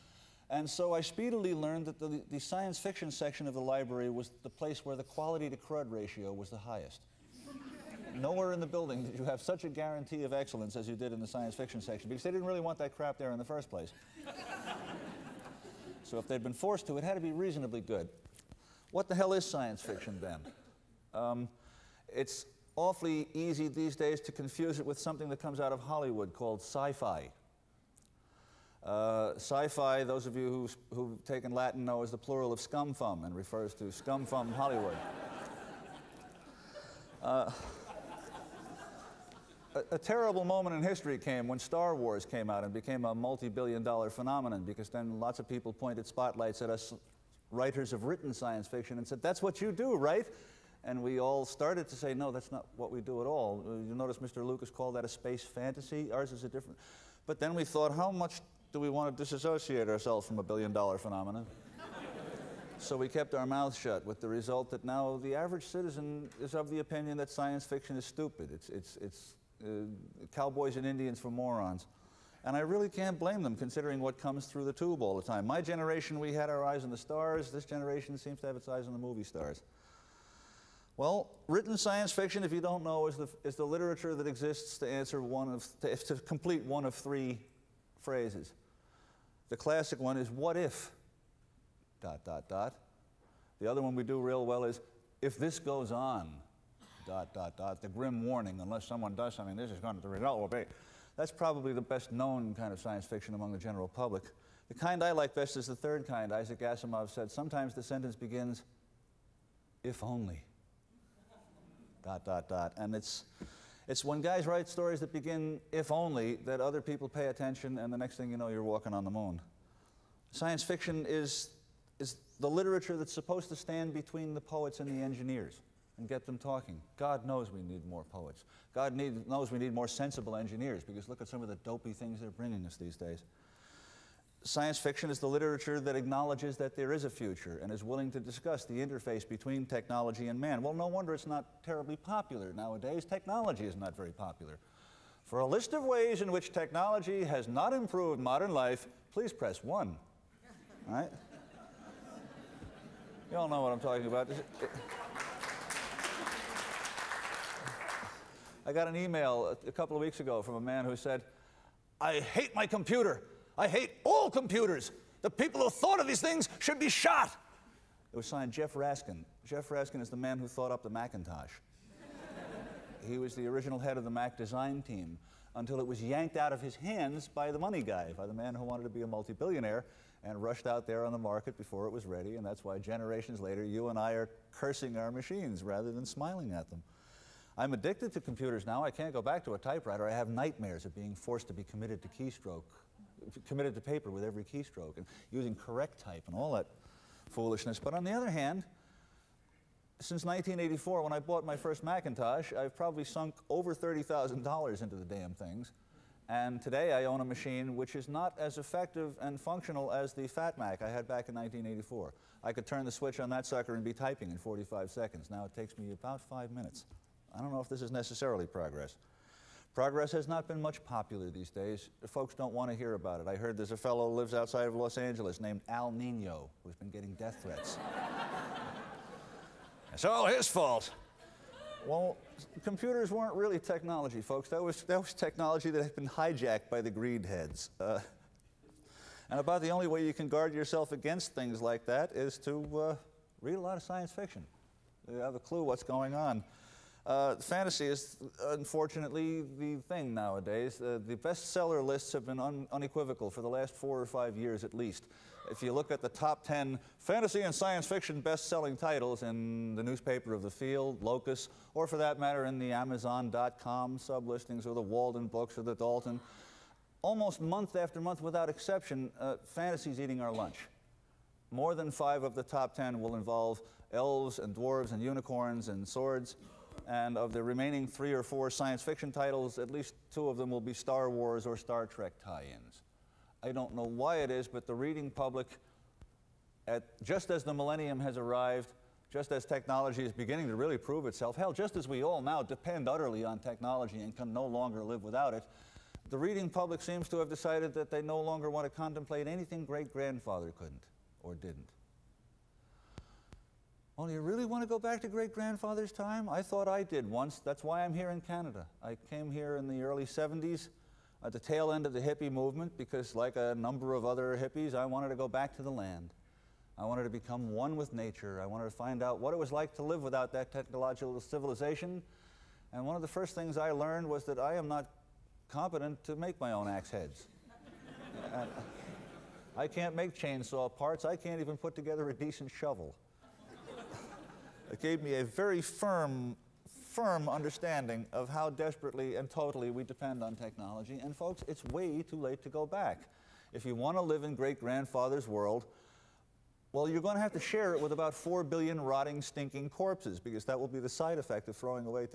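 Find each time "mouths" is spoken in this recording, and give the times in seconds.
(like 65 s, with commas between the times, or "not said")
63 s.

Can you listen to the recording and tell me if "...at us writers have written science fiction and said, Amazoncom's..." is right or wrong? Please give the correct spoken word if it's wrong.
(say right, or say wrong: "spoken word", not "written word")
wrong: "That", not "Amazoncom".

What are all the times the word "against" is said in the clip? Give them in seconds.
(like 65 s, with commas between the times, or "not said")
240 s.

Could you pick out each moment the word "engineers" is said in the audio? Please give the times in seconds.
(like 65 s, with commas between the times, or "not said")
125 s, 130 s.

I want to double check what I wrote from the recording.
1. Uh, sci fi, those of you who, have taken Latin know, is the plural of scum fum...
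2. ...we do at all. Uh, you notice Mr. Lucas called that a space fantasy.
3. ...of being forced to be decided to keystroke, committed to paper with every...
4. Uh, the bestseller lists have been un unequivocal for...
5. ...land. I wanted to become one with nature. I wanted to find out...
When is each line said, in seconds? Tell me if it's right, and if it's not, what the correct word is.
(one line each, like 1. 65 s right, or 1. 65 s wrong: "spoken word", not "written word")
1. 28 s right
2. 52 s right
3. 190 s wrong: "committed", not "decided"
4. 250 s right
5. 315 s right.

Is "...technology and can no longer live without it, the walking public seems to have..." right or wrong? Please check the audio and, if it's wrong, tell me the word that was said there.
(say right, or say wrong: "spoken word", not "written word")
wrong: "reading", not "walking".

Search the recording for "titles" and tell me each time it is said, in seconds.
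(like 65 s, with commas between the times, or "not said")
258 s, 279 s.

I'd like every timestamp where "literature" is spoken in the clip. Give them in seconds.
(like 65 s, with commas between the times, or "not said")
83 s, 122 s, 135 s.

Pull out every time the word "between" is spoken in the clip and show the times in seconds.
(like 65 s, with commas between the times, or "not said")
123 s, 139 s.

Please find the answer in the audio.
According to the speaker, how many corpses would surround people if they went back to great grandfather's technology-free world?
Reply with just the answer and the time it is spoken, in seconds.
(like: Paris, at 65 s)
4 billion, at 348 s.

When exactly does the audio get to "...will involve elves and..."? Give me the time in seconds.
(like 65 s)
273 s.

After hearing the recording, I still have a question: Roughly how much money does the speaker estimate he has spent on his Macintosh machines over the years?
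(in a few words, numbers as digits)
$30,000.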